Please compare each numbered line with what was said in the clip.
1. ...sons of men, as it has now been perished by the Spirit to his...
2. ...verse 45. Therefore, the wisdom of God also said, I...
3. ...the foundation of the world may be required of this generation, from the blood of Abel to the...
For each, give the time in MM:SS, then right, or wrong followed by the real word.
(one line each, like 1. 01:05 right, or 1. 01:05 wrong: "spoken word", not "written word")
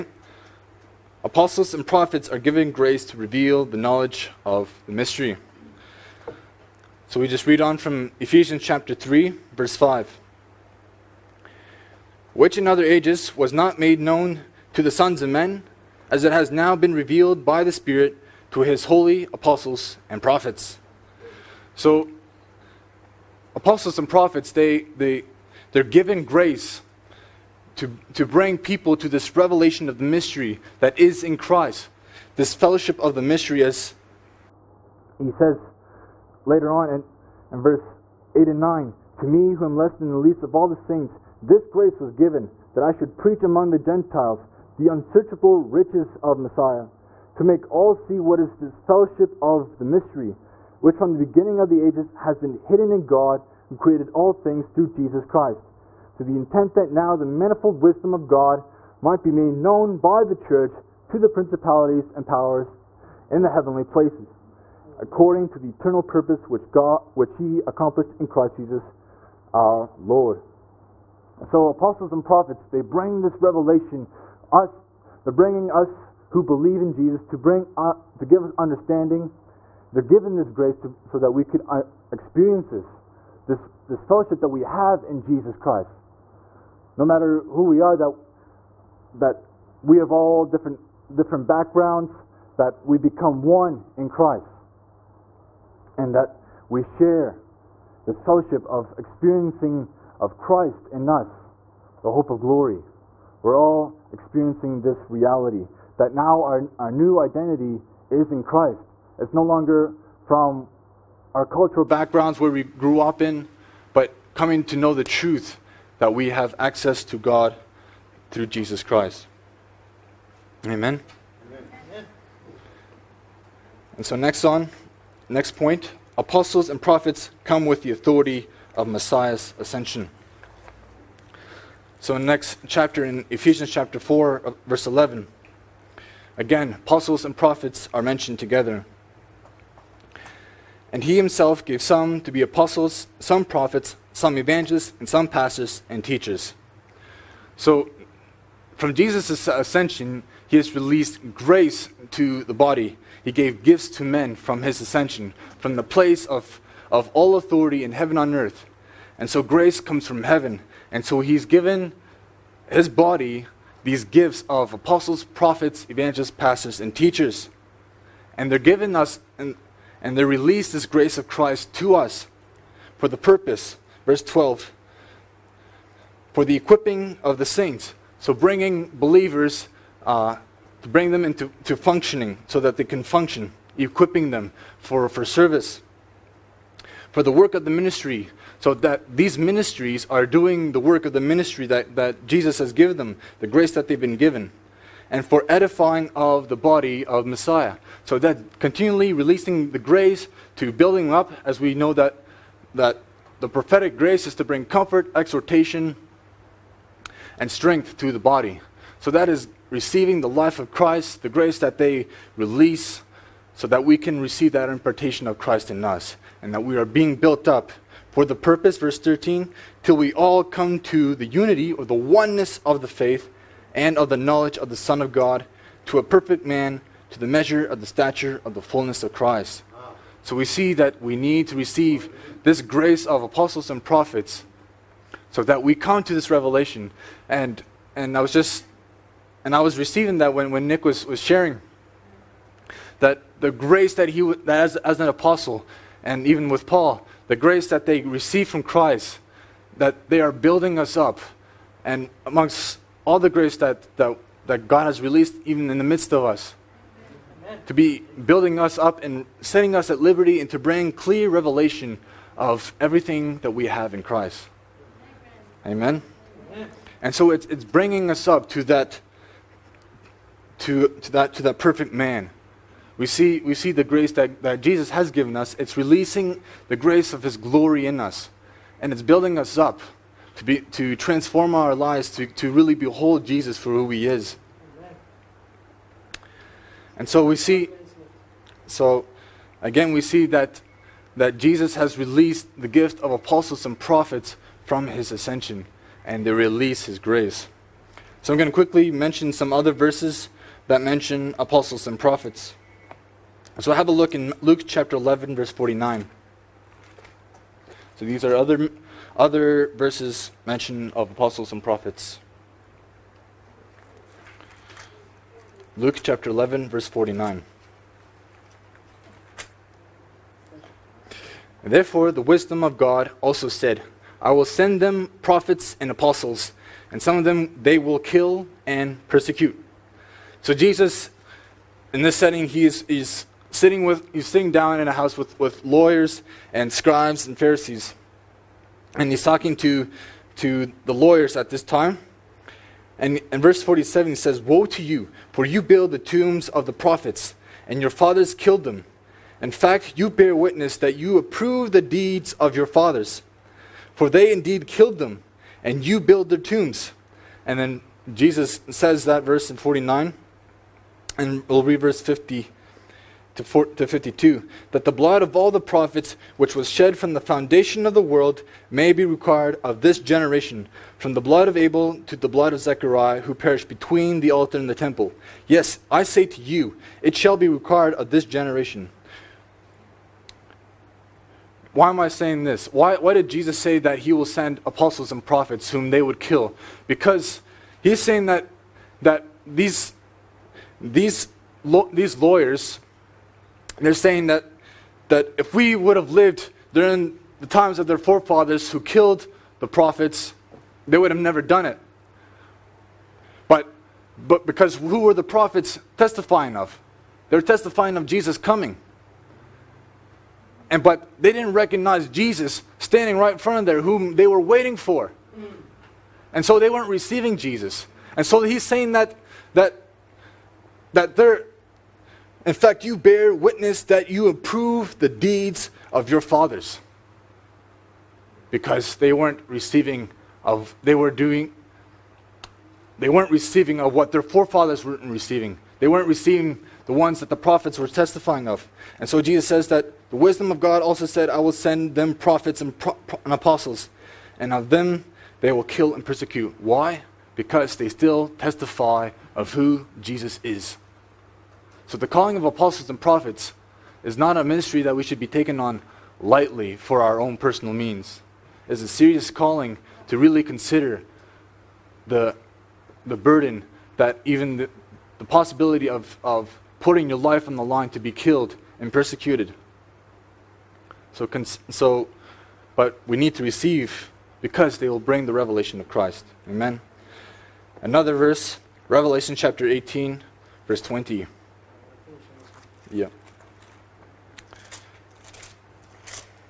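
1. 00:14 wrong: "revealed", not "perished"
2. 05:16 wrong: "49", not "45"
3. 06:07 right.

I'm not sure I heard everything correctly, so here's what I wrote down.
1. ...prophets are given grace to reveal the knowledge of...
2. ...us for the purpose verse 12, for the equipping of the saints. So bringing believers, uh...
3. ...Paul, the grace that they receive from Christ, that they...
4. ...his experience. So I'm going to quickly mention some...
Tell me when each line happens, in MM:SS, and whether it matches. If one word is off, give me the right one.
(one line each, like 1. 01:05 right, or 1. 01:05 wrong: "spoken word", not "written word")
1. 00:01 right
2. 02:51 right
3. 04:06 right
4. 04:56 wrong: "grace", not "experience".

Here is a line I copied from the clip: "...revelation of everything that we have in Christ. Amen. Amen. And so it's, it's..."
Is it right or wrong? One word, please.
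right.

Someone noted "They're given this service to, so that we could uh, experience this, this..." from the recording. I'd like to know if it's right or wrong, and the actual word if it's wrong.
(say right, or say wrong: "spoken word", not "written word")
wrong: "grace", not "service".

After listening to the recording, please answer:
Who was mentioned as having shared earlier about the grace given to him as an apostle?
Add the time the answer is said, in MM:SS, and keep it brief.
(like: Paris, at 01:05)
Nick, at 04:00.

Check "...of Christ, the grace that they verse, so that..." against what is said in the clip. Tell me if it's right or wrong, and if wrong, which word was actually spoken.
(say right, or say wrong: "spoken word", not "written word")
wrong: "release", not "verse".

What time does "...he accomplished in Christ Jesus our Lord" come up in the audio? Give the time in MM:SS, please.
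01:07.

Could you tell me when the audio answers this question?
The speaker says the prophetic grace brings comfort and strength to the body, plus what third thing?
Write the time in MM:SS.
03:25.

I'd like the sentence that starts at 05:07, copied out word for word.
So these are other, other verses mentioned of apostles and prophets.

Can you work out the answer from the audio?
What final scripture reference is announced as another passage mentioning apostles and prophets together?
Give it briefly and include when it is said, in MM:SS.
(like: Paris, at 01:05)
Revelation 18:20, at 07:58.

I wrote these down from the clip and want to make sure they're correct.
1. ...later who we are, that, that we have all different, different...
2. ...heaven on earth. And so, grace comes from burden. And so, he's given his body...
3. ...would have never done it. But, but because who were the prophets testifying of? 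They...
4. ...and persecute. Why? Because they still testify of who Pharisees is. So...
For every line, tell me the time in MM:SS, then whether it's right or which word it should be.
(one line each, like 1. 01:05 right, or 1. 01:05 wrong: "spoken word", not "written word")
1. 01:27 wrong: "matter", not "later"
2. 02:37 wrong: "heaven", not "burden"
3. 06:40 right
4. 07:25 wrong: "Jesus", not "Pharisees".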